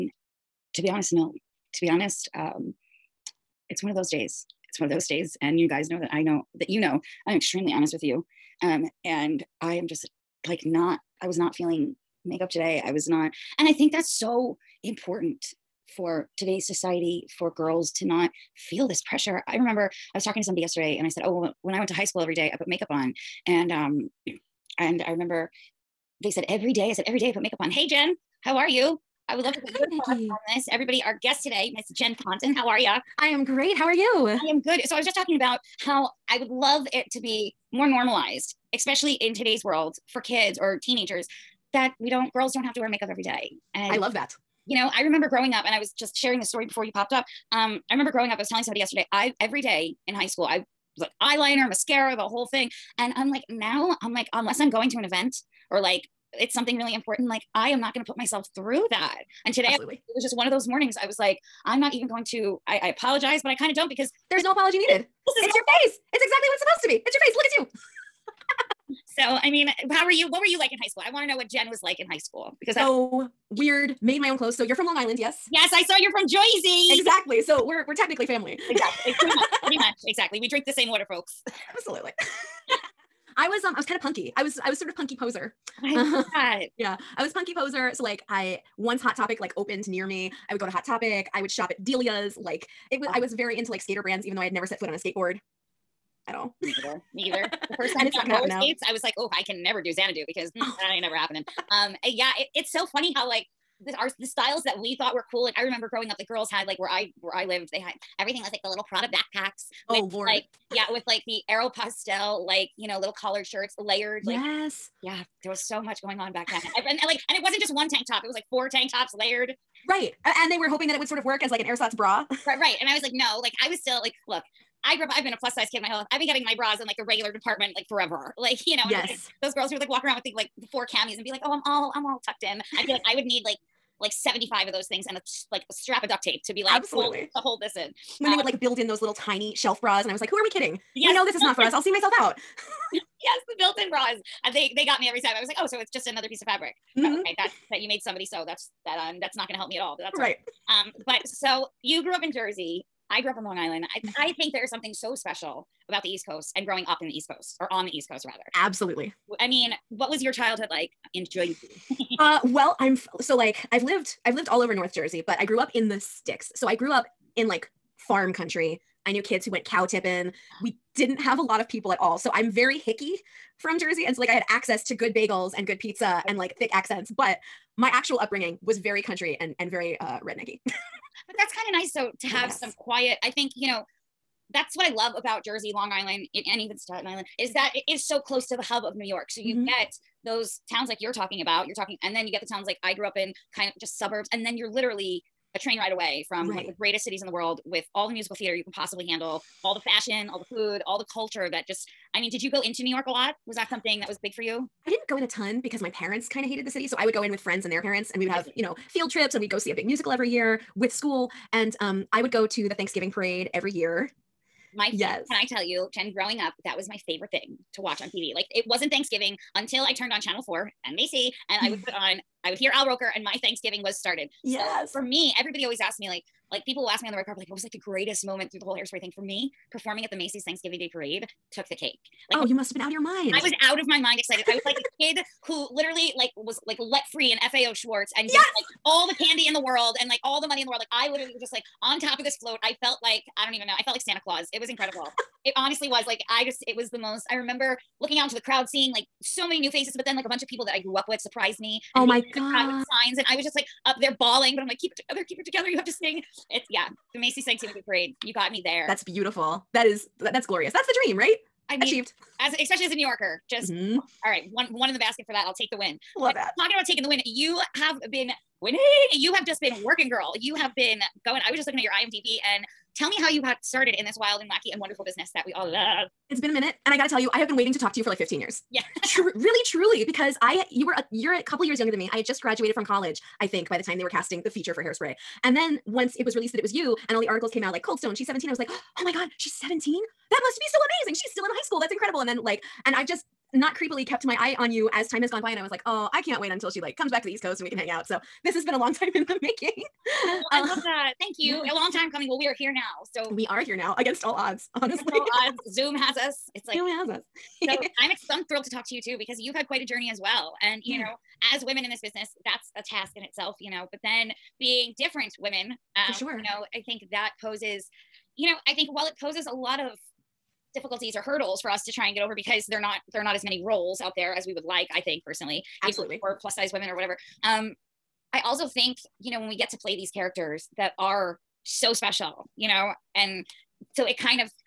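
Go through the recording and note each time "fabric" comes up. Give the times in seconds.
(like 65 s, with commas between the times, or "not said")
146 s.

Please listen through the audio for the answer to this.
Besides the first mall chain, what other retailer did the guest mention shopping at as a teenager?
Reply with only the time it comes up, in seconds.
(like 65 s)
91 s.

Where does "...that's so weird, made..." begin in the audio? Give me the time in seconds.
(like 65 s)
72 s.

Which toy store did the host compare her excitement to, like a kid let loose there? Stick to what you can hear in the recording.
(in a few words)
FAO Schwarz.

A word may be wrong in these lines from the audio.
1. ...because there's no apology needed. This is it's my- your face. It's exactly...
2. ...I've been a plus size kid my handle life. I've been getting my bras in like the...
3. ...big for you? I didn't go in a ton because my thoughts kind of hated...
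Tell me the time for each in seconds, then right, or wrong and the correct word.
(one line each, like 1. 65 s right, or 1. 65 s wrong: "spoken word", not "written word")
1. 63 s right
2. 125 s wrong: "whole", not "handle"
3. 204 s wrong: "parents", not "thoughts".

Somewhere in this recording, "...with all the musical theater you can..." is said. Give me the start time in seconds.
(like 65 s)
197 s.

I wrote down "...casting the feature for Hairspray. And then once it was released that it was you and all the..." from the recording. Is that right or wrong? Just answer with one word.
right.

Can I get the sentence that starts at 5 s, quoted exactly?
And you guys know that I know that you know I'm extremely honest with you.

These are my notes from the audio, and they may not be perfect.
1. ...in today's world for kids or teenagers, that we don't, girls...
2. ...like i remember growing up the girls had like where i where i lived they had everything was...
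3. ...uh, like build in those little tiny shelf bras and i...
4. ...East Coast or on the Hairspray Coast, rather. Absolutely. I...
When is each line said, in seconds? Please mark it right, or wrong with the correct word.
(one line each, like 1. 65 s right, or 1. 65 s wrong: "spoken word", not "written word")
1. 39 s right
2. 105 s right
3. 138 s right
4. 157 s wrong: "East", not "Hairspray".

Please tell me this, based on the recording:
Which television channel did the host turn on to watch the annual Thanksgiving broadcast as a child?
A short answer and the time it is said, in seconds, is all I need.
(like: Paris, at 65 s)
Channel 4, at 220 s.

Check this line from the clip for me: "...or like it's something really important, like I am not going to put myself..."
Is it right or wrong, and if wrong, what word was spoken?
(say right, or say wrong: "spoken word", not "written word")
right.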